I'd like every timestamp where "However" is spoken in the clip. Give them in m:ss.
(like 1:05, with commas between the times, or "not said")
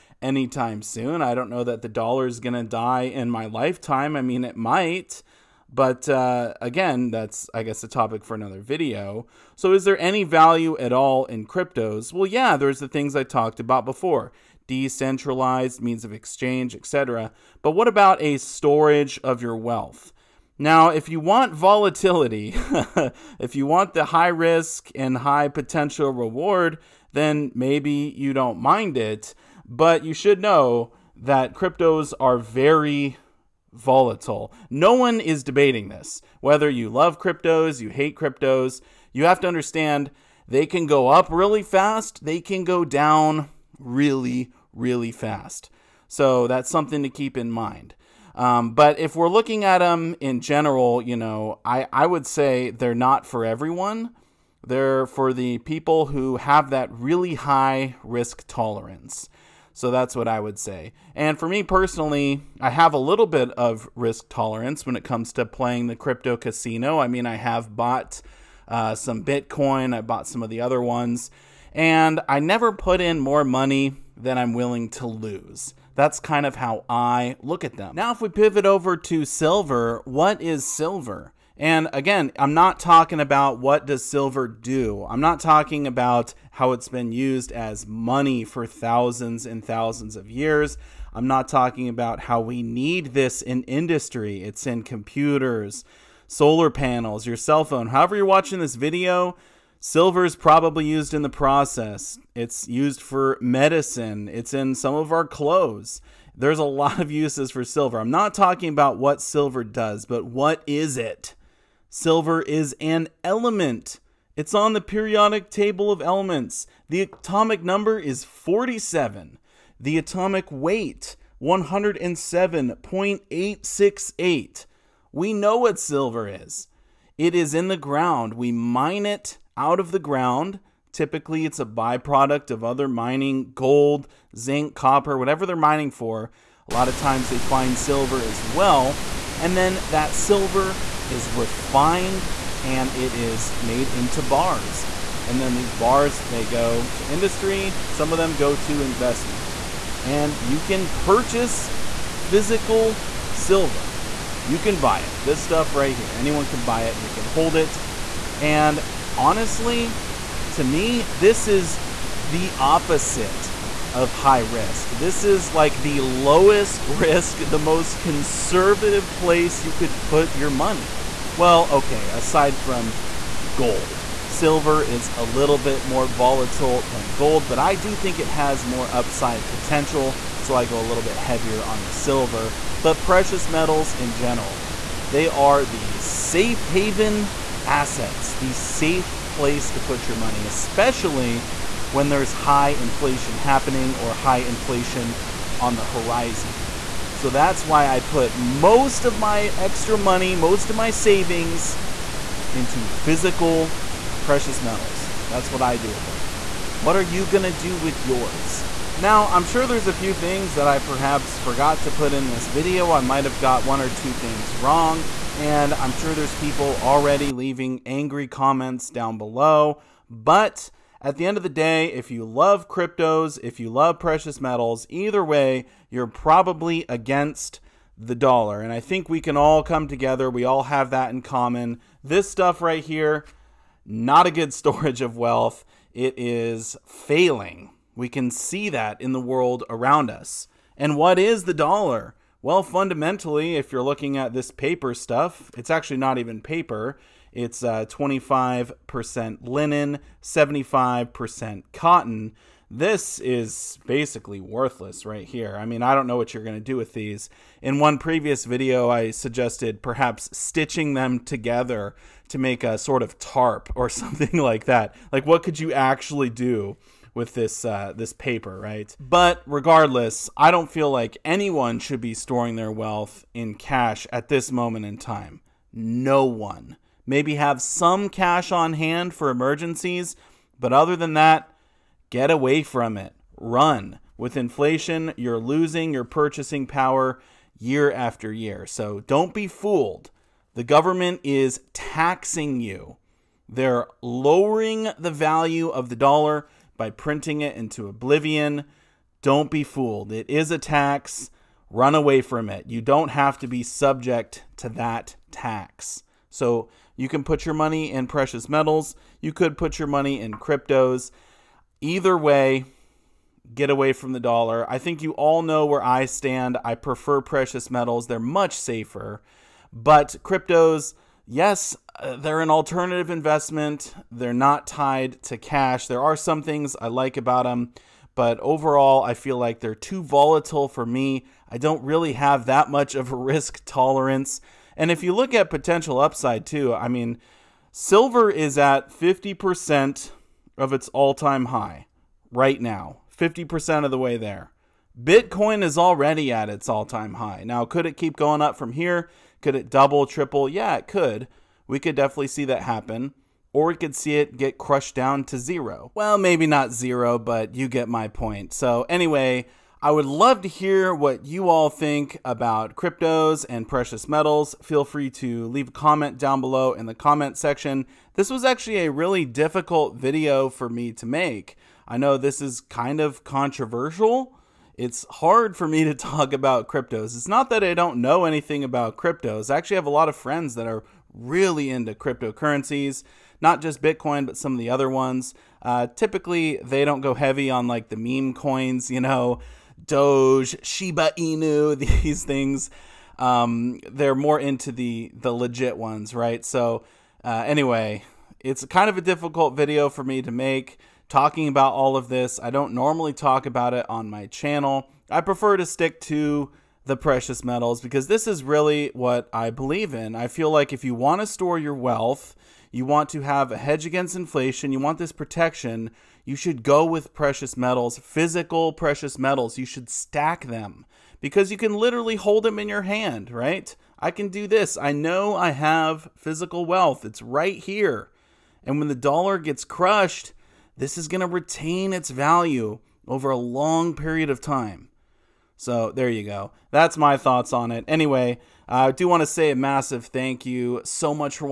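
1:37.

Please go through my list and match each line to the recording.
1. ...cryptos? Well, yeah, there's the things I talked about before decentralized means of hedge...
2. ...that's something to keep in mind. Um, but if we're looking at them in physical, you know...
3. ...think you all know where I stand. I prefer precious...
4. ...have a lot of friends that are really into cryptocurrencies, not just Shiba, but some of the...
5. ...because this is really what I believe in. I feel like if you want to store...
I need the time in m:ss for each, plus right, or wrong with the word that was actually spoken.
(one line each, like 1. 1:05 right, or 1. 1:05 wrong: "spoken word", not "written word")
1. 0:11 wrong: "exchange", not "hedge"
2. 0:46 wrong: "general", not "physical"
3. 5:14 right
4. 6:19 wrong: "Bitcoin", not "Shiba"
5. 6:47 right.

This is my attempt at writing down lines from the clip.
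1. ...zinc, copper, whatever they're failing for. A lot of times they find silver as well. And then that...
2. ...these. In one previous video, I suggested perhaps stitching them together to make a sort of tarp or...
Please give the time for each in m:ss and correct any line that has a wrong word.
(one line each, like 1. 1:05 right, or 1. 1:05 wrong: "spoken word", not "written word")
1. 2:14 wrong: "mining", not "failing"
2. 4:16 right.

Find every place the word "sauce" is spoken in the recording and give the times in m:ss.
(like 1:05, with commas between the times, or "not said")
not said.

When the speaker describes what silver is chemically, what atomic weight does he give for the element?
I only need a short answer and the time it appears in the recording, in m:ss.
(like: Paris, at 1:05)
107.868, at 2:01.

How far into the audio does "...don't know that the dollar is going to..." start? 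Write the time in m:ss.
0:01.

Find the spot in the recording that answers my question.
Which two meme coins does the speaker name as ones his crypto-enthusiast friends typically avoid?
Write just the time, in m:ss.
6:29.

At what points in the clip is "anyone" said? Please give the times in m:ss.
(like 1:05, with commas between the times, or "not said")
2:36, 4:31.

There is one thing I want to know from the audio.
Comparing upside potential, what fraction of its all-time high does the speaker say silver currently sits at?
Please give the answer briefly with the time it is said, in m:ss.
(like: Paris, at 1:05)
50%, at 5:38.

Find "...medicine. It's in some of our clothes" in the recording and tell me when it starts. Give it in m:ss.
1:43.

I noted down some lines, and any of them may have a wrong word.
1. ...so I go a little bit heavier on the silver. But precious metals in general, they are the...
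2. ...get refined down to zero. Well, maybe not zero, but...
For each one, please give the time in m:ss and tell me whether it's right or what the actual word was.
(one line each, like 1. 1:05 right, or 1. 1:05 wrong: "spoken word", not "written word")
1. 3:00 right
2. 5:54 wrong: "crushed", not "refined".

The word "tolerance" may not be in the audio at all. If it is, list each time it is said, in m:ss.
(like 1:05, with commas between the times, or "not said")
0:58, 1:04, 5:33.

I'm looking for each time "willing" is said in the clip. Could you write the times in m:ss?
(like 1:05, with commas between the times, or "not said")
1:14.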